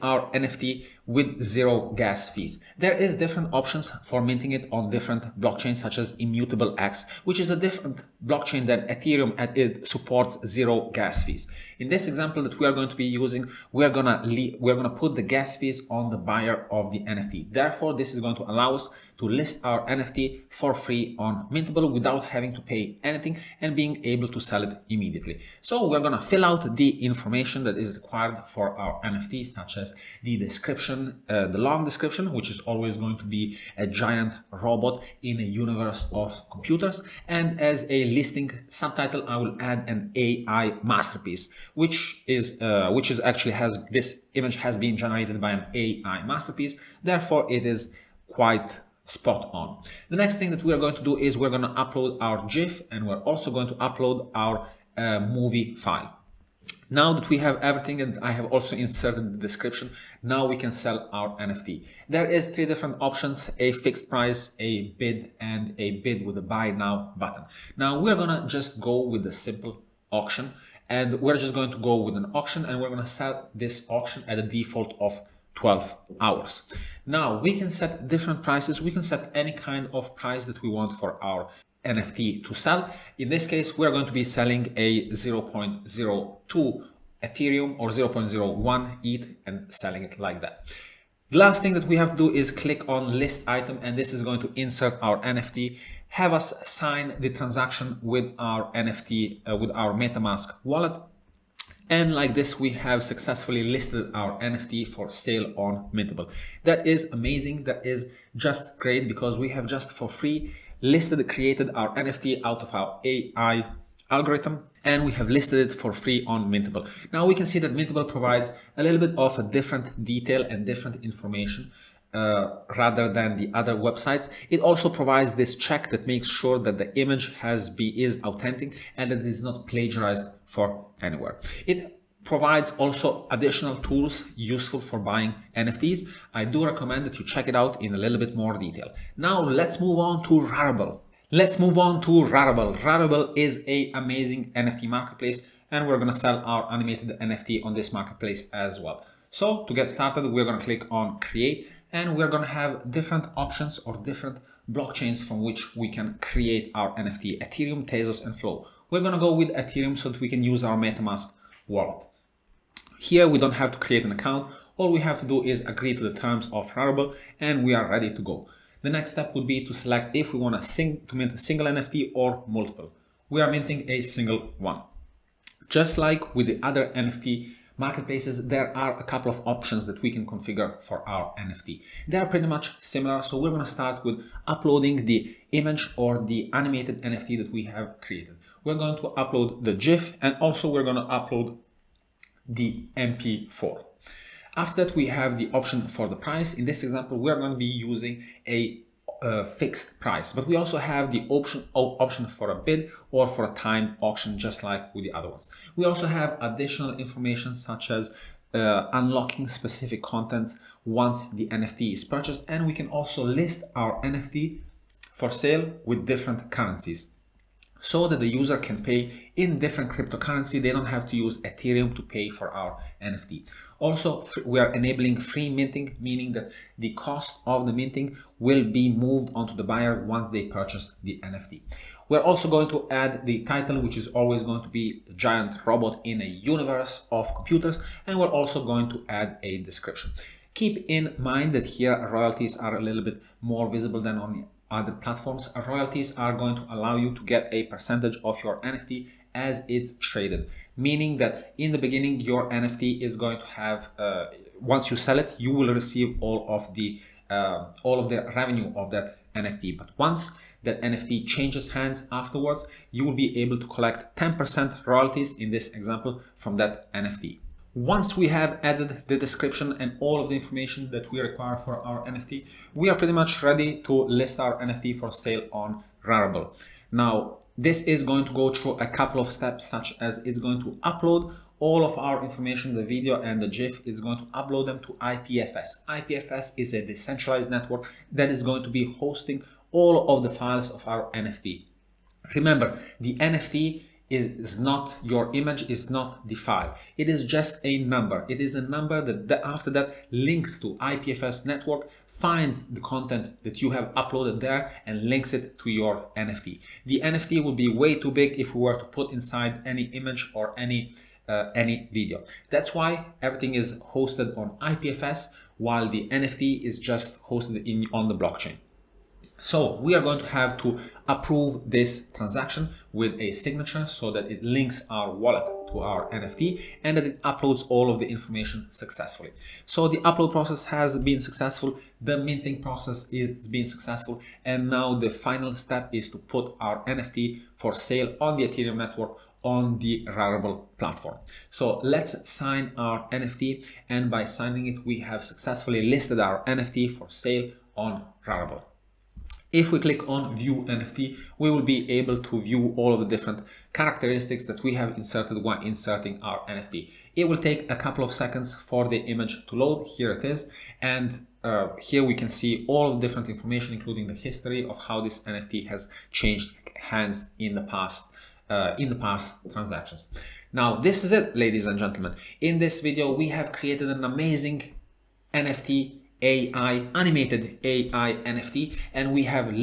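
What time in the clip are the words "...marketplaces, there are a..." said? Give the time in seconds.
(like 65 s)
177 s.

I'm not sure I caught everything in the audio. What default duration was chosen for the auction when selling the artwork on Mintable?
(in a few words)
12 hours.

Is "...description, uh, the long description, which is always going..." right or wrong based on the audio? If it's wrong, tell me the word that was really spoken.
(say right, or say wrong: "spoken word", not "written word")
right.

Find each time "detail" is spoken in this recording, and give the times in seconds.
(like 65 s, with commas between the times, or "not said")
120 s, 138 s.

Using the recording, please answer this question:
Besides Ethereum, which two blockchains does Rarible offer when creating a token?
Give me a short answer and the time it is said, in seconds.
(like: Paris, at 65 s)
Tezos and Flow, at 157 s.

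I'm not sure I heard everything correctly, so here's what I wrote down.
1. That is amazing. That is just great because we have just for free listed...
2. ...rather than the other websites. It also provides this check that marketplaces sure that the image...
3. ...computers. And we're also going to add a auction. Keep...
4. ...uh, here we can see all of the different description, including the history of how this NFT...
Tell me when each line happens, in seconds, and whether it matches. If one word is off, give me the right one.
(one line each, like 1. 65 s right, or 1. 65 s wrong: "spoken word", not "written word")
1. 106 s right
2. 122 s wrong: "makes", not "marketplaces"
3. 237 s wrong: "description", not "auction"
4. 361 s wrong: "information", not "description".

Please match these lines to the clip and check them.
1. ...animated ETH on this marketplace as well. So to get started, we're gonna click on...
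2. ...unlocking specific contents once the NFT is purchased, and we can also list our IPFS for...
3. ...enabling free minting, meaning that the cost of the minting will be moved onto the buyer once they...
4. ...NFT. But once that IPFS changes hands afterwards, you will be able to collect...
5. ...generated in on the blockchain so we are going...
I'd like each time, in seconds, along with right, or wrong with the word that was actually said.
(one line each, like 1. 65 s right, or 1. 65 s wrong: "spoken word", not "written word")
1. 146 s wrong: "NFT", not "ETH"
2. 208 s wrong: "NFT", not "IPFS"
3. 224 s right
4. 259 s wrong: "NFT", not "IPFS"
5. 317 s wrong: "hosted", not "generated".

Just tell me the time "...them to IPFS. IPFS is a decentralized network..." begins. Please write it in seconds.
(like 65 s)
284 s.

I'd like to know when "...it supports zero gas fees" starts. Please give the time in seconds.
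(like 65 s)
9 s.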